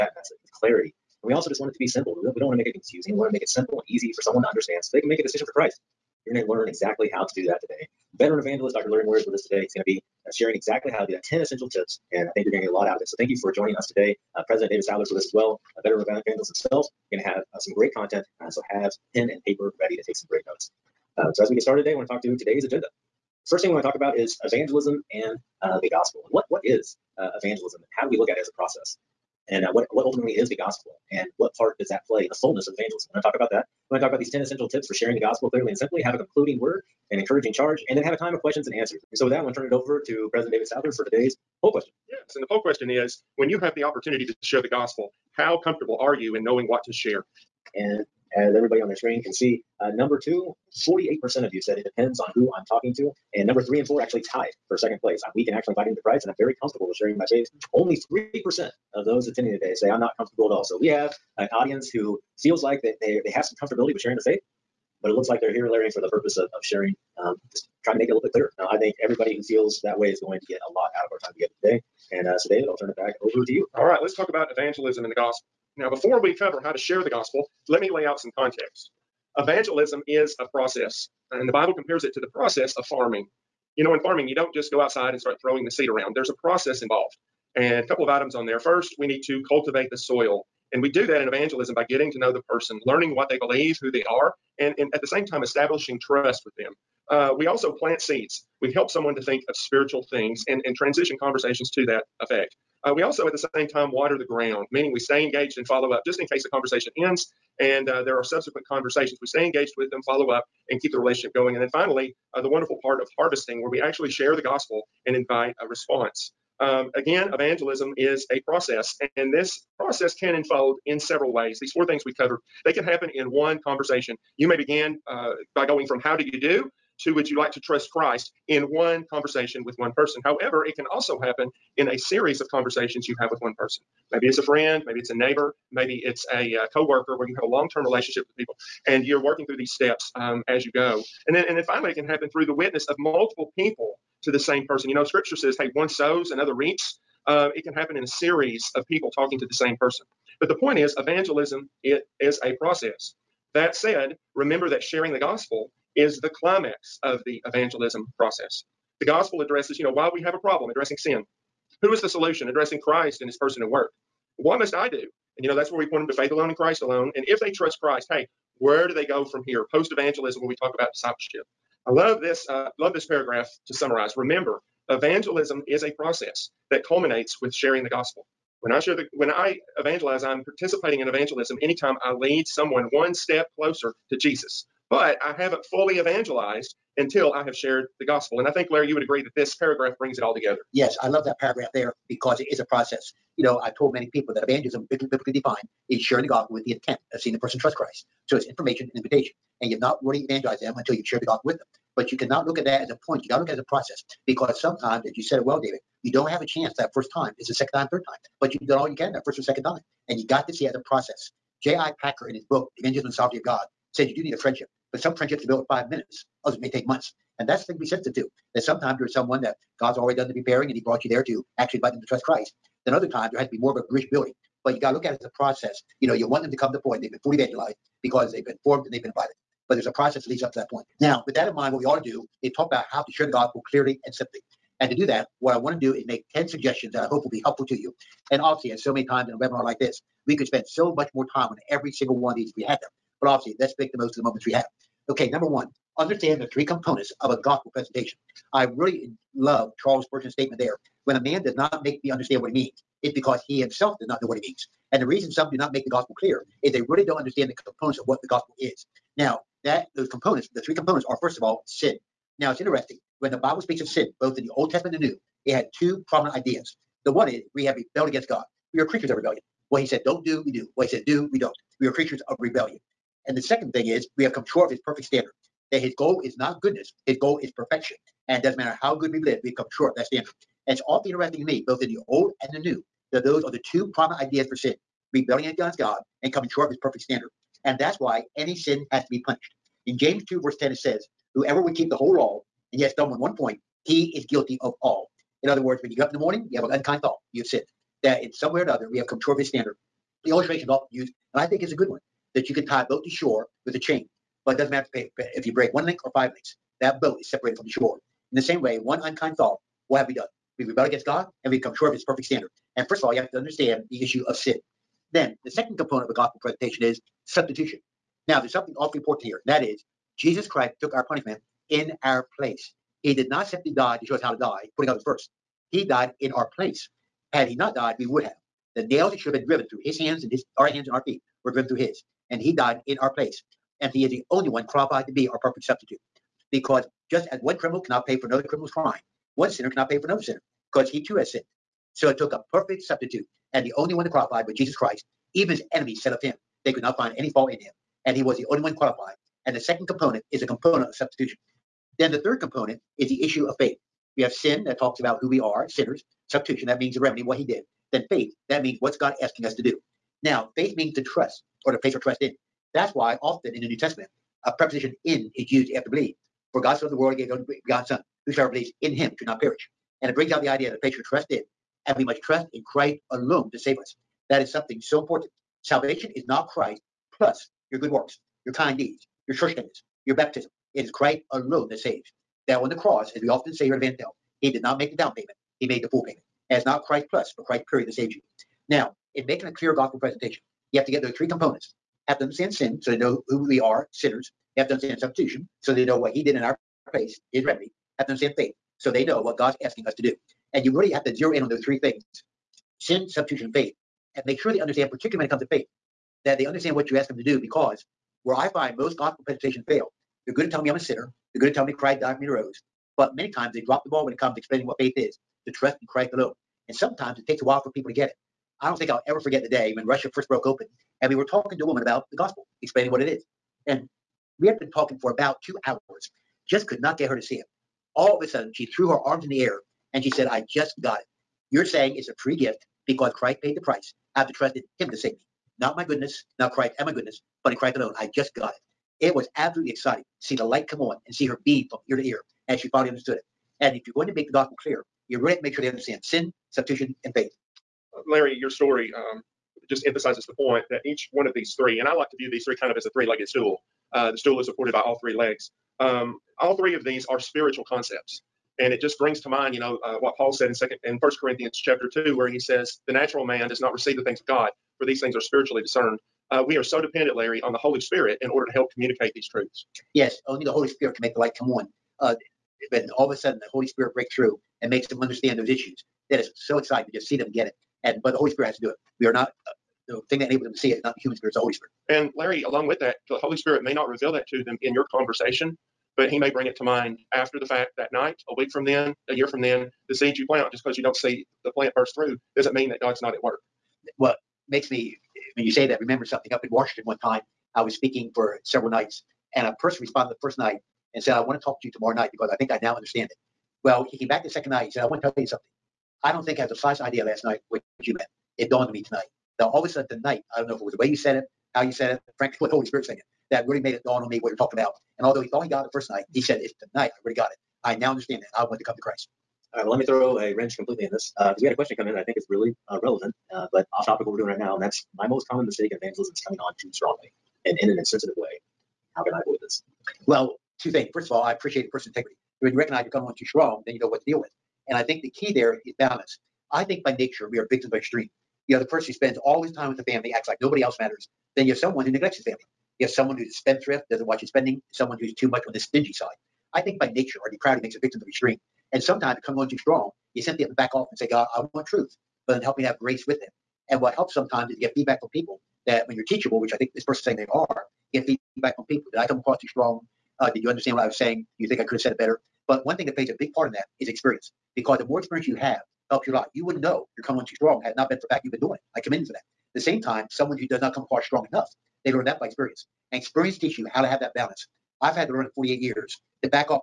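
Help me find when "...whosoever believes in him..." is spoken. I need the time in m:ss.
6:08.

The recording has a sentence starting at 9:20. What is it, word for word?
Uh, did you understand what I was saying?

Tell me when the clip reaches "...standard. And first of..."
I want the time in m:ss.
5:12.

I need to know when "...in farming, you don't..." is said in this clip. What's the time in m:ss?
1:23.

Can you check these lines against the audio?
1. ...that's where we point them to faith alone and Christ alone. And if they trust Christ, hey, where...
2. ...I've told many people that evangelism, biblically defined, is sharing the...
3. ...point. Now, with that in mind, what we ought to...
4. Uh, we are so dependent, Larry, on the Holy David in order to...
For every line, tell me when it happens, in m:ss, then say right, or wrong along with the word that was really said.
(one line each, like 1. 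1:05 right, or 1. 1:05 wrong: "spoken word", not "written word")
1. 2:45 right
2. 3:13 right
3. 3:50 right
4. 7:46 wrong: "Spirit", not "David".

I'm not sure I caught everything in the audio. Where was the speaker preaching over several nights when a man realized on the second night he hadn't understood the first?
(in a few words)
Washington.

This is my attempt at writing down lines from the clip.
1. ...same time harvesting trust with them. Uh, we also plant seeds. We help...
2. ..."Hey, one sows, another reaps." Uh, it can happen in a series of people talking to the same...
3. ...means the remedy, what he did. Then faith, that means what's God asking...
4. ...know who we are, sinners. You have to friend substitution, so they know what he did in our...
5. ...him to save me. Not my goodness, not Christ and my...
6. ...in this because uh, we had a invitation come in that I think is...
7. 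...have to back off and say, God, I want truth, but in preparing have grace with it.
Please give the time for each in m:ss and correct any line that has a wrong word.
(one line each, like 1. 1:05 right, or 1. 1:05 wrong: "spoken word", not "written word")
1. 1:35 wrong: "establishing", not "harvesting"
2. 2:25 right
3. 5:56 right
4. 6:32 wrong: "understand", not "friend"
5. 7:14 right
6. 8:40 wrong: "question", not "invitation"
7. 9:10 wrong: "helping", not "preparing".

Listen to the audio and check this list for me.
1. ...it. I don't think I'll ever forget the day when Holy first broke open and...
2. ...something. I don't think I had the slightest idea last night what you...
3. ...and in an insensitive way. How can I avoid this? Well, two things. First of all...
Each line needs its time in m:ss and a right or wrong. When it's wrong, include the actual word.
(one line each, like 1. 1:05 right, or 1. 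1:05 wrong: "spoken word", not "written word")
1. 6:58 wrong: "Russia", not "Holy"
2. 8:25 right
3. 8:47 right.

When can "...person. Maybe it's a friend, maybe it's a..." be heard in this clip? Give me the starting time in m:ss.
2:13.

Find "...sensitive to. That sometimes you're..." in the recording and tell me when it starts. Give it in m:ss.
3:37.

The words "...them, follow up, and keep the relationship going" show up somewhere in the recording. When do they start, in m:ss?
1:49.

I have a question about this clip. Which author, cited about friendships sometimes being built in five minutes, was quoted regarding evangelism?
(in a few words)
J.I. Packer.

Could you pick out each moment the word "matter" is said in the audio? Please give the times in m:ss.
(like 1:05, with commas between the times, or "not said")
4:38, 5:04, 9:00.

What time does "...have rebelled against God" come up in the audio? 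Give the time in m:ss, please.
4:27.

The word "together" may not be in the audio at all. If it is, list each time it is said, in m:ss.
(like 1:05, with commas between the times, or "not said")
1:11, 3:10.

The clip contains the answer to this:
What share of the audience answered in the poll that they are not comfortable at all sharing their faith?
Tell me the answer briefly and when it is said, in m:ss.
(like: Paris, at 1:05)
3%, at 0:58.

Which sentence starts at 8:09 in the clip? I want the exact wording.
The seeds you plant, just because you don't see the plant burst through, doesn't mean that God's not at work.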